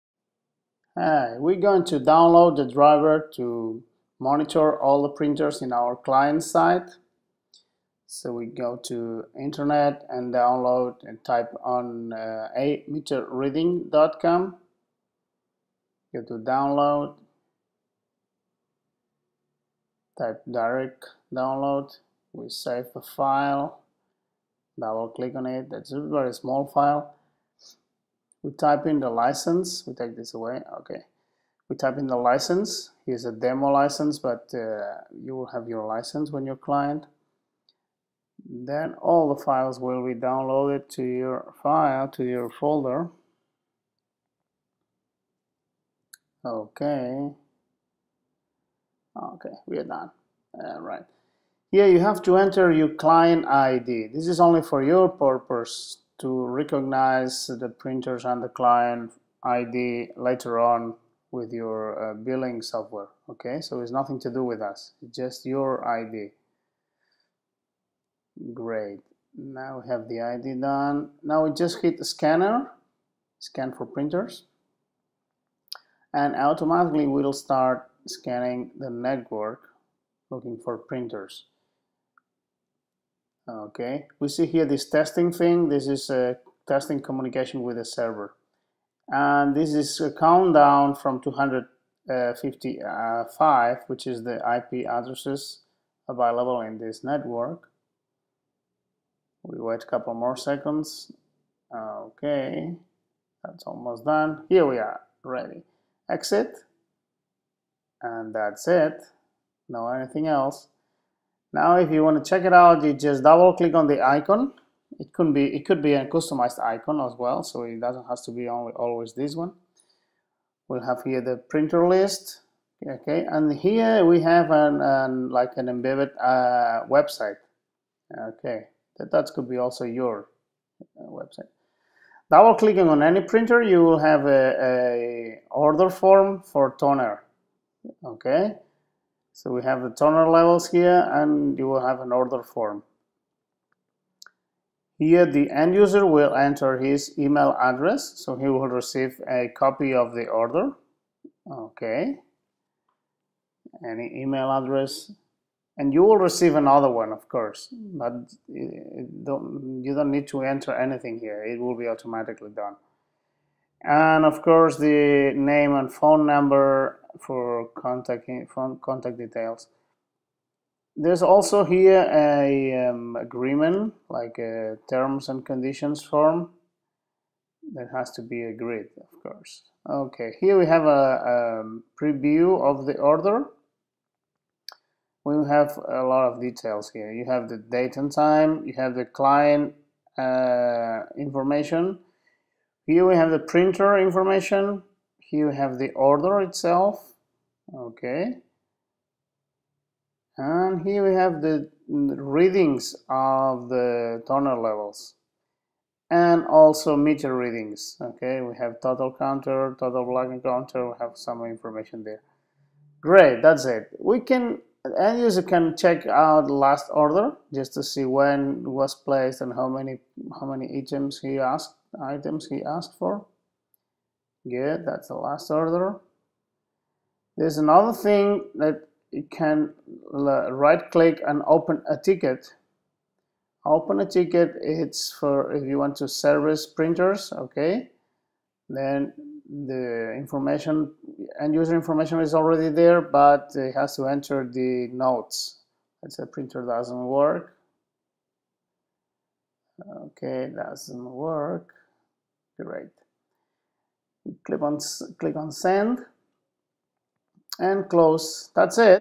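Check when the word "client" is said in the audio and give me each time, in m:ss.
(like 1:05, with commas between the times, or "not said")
0:05, 0:36, 0:52, 0:58, 3:09.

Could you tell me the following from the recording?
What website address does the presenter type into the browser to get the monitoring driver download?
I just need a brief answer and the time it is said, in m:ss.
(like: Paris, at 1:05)
meterreading.com, at 0:12.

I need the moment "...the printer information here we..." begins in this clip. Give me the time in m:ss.
3:13.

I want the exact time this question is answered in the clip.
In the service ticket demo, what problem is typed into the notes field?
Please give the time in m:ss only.
4:06.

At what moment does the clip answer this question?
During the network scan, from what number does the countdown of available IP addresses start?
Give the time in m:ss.
1:31.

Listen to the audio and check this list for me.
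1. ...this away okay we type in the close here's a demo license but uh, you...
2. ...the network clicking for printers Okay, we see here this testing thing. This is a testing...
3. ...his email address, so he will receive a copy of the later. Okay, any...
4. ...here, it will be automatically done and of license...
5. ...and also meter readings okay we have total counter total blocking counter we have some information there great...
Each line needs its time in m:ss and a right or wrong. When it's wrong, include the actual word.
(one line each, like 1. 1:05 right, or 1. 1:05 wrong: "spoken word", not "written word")
1. 0:30 wrong: "license", not "close"
2. 1:18 wrong: "looking", not "clicking"
3. 2:26 wrong: "order", not "later"
4. 2:41 wrong: "course", not "license"
5. 3:26 right.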